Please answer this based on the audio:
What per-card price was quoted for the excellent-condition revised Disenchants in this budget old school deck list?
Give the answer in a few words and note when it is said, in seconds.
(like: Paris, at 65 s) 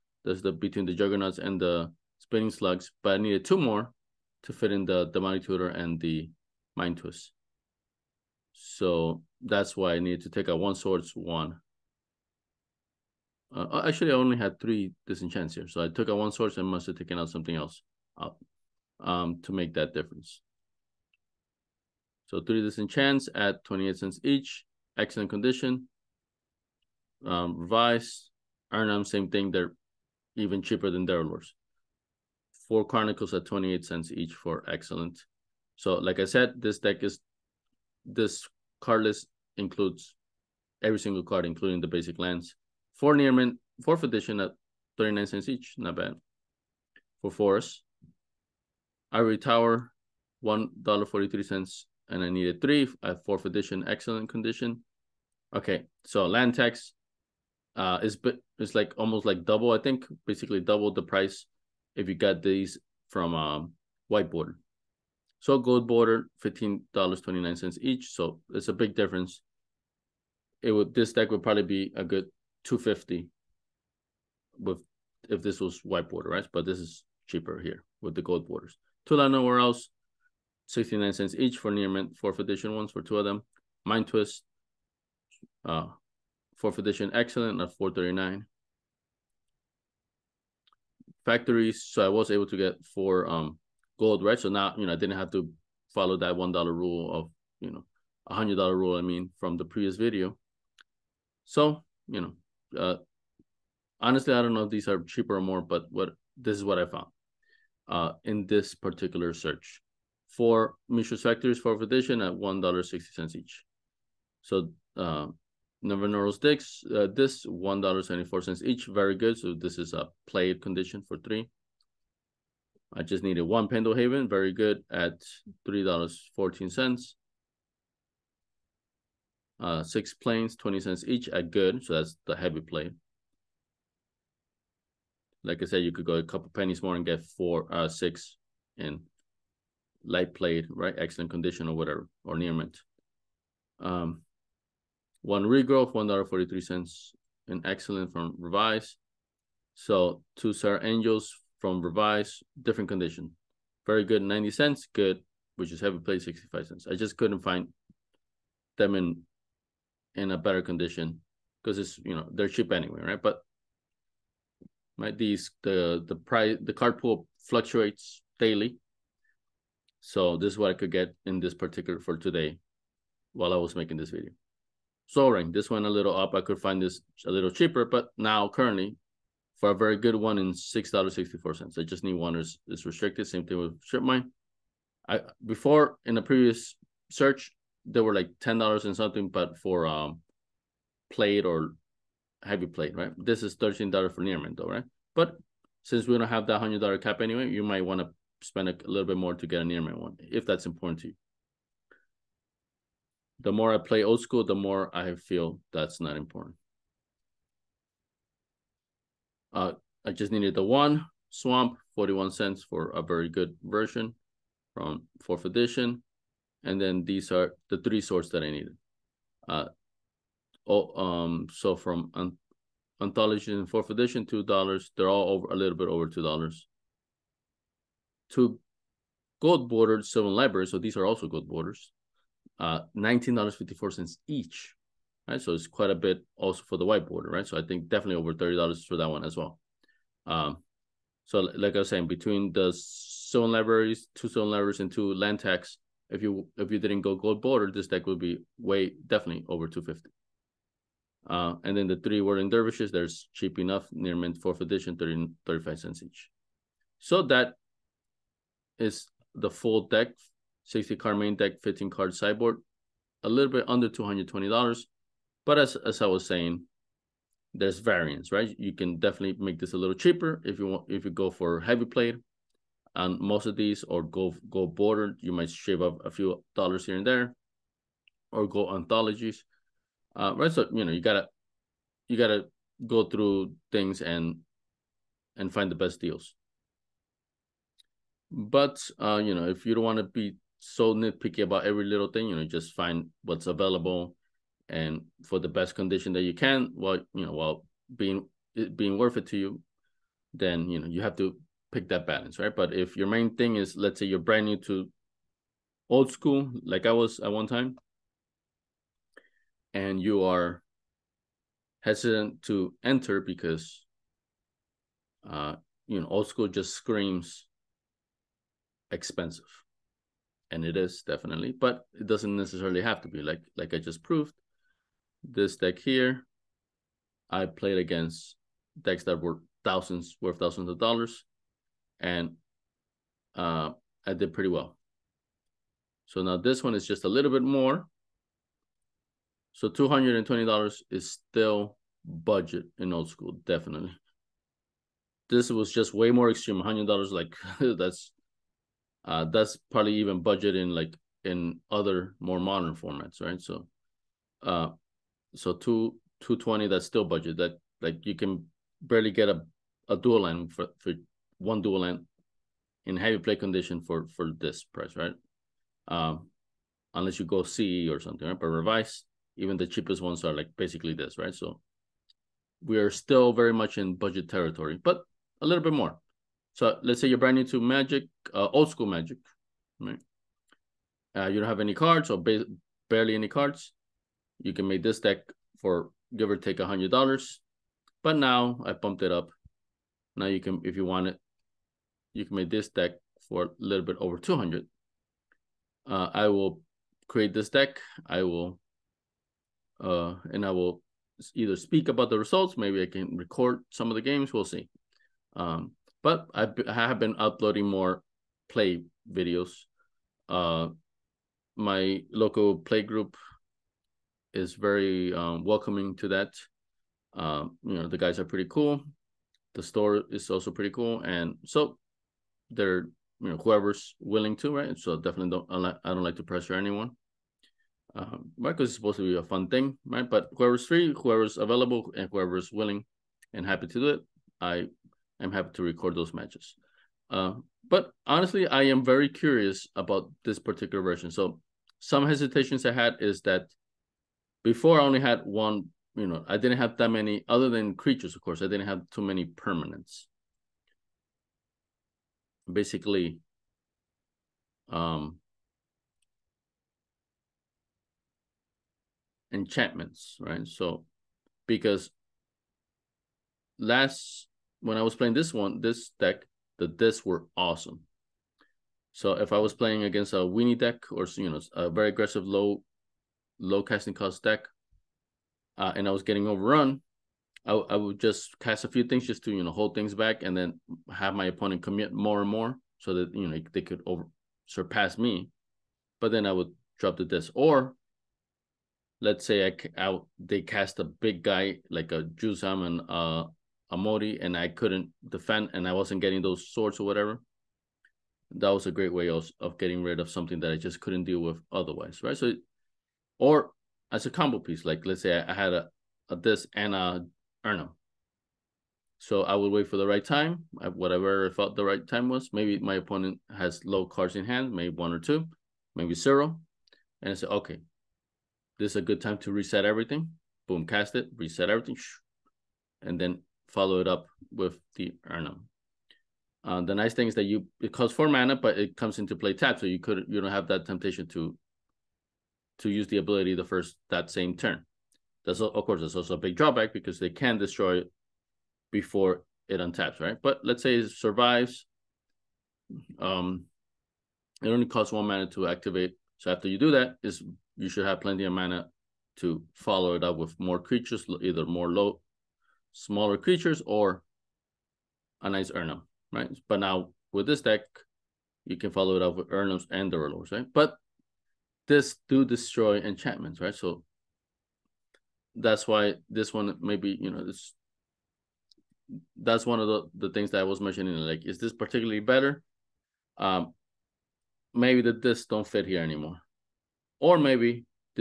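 28 cents, at 23 s.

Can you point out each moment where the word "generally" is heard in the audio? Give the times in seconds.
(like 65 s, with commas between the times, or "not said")
not said.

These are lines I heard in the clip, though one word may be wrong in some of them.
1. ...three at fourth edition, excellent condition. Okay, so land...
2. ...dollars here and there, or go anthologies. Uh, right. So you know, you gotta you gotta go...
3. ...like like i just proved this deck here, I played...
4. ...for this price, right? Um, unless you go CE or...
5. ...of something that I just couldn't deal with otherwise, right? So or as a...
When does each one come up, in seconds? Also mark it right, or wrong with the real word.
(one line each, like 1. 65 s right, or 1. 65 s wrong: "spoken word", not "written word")
1. 52 s right
2. 276 s right
3. 323 s right
4. 364 s right
5. 499 s right.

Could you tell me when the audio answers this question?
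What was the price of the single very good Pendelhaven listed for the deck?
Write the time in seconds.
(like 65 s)
125 s.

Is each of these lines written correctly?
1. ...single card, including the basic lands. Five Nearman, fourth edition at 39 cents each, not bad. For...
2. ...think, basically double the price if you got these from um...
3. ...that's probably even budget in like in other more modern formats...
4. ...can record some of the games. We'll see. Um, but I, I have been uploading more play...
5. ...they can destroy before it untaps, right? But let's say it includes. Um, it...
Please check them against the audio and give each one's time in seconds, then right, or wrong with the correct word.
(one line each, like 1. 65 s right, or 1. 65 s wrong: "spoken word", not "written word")
1. 40 s wrong: "Four", not "Five"
2. 59 s right
3. 349 s right
4. 402 s right
5. 536 s wrong: "survives", not "includes".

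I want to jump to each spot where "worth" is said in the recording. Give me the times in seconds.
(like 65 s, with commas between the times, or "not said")
298 s, 330 s.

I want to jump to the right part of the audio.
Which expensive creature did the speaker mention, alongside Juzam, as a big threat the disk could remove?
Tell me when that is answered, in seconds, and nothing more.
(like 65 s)
493 s.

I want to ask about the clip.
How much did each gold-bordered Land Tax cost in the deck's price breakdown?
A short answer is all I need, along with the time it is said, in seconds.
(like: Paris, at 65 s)
$15.29, at 66 s.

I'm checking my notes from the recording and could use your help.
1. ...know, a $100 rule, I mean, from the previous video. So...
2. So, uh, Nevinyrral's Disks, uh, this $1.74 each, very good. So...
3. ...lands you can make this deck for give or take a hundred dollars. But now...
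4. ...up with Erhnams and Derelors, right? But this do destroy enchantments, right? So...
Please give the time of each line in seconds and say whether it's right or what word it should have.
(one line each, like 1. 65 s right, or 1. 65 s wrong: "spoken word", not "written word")
1. 97 s right
2. 114 s right
3. 383 s wrong: "cards", not "lands"
4. 559 s right.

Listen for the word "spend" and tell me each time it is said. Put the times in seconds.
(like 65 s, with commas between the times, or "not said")
198 s.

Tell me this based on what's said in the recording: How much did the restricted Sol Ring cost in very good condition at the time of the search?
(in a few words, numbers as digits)
$6.64.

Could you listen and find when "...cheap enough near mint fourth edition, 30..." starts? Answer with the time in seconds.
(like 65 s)
253 s.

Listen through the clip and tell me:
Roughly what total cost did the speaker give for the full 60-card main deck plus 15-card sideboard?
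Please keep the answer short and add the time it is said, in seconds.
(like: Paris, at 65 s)
under $220, at 263 s.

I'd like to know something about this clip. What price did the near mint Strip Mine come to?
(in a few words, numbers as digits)
$13.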